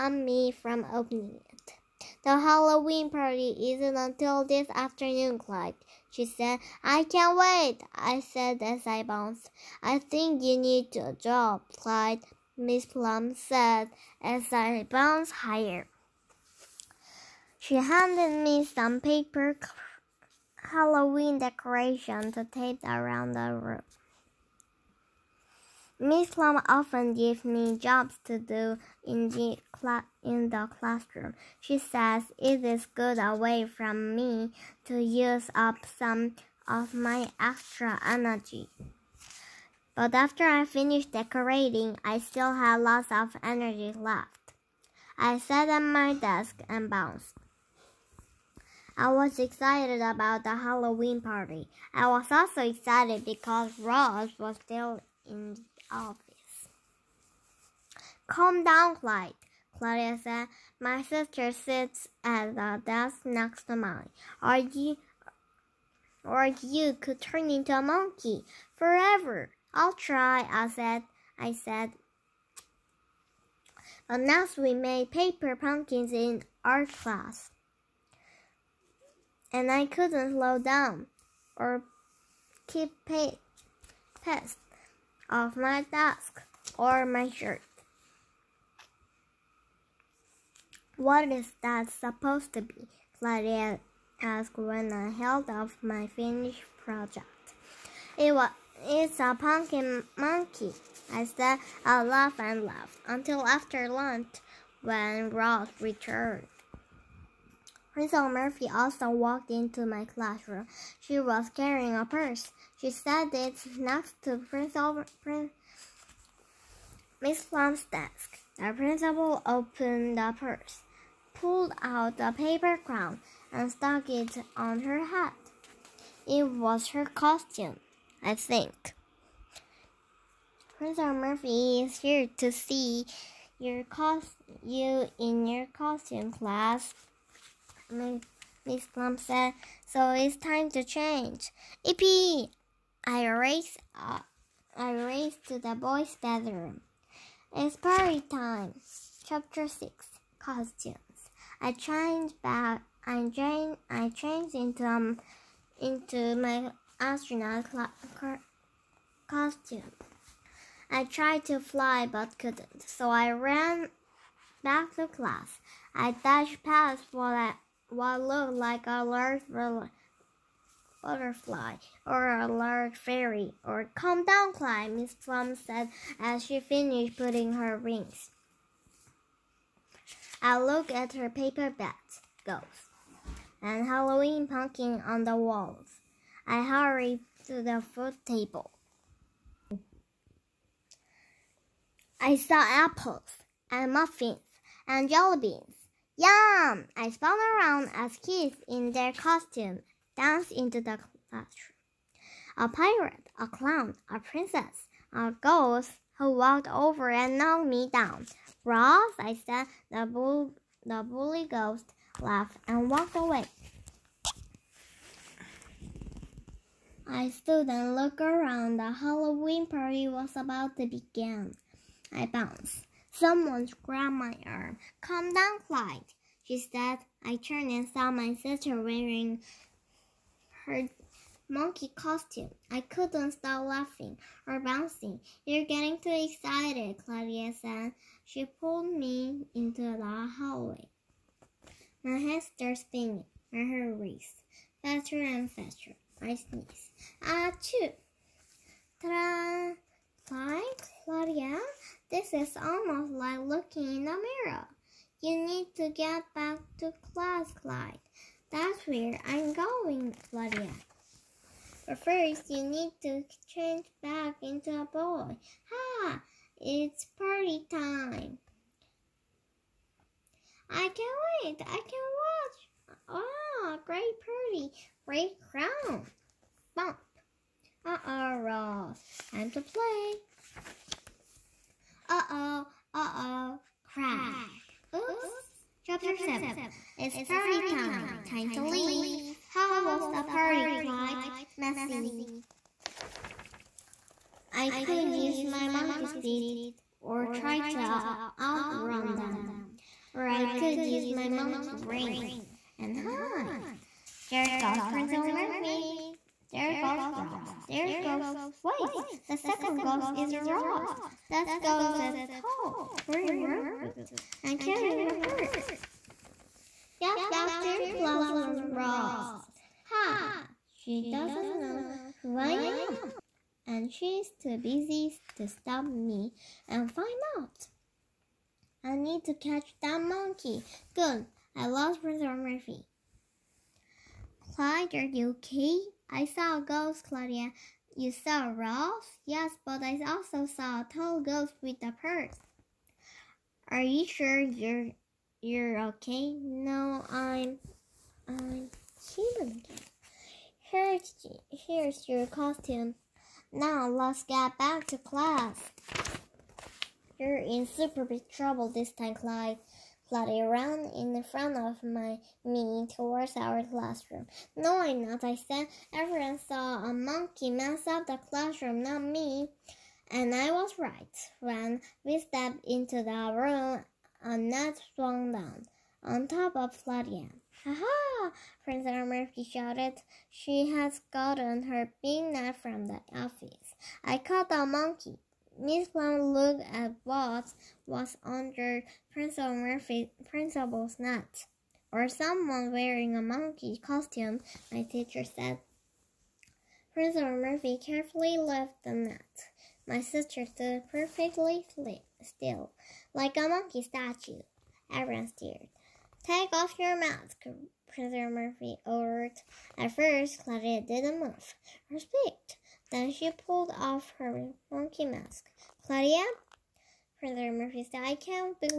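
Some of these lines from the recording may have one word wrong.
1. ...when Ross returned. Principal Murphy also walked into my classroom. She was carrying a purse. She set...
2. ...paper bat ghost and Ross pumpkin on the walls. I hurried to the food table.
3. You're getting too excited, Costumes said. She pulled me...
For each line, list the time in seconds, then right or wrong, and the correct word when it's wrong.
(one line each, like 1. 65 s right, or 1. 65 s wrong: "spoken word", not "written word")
1. 104 s right
2. 181 s wrong: "Halloween", not "Ross"
3. 235 s wrong: "Claudia", not "Costumes".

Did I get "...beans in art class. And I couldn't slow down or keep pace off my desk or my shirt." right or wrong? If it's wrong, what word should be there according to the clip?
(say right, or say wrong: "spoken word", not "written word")
wrong: "pumpkins", not "beans".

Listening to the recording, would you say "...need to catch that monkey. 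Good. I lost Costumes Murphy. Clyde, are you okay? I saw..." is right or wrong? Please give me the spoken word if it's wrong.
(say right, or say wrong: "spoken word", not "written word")
wrong: "Professor", not "Costumes".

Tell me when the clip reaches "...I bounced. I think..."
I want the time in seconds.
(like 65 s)
8 s.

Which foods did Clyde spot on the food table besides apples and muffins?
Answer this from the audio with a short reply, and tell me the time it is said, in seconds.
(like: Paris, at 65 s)
jelly beans, at 195 s.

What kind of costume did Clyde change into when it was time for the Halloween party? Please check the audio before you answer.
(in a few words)
astronaut costume.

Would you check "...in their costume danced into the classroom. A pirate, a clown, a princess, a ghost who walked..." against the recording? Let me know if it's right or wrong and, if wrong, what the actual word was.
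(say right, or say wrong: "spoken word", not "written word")
right.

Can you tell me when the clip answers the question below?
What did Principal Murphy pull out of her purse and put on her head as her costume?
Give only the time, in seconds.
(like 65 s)
122 s.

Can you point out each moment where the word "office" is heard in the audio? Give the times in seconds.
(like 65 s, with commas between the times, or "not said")
55 s, 383 s.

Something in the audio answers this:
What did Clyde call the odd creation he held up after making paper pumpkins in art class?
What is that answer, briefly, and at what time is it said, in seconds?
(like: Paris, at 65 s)
pumpkin monkey, at 99 s.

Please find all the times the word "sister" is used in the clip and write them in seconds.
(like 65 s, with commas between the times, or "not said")
61 s, 228 s, 400 s.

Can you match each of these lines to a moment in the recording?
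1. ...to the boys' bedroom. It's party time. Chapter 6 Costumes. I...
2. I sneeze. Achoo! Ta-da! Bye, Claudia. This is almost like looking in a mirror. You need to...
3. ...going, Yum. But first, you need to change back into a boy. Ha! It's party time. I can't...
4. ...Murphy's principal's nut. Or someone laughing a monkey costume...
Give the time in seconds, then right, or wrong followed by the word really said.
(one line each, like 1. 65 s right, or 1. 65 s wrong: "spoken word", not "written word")
1. 145 s right
2. 246 s right
3. 259 s wrong: "Claudia", not "Yum"
4. 389 s wrong: "wearing", not "laughing".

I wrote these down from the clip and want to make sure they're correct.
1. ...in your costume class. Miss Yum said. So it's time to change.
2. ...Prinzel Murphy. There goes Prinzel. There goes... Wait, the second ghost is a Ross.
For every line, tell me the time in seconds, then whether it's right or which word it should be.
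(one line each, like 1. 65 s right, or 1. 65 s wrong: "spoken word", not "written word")
1. 135 s wrong: "Plum", not "Yum"
2. 304 s wrong: "Ross", not "Prinzel".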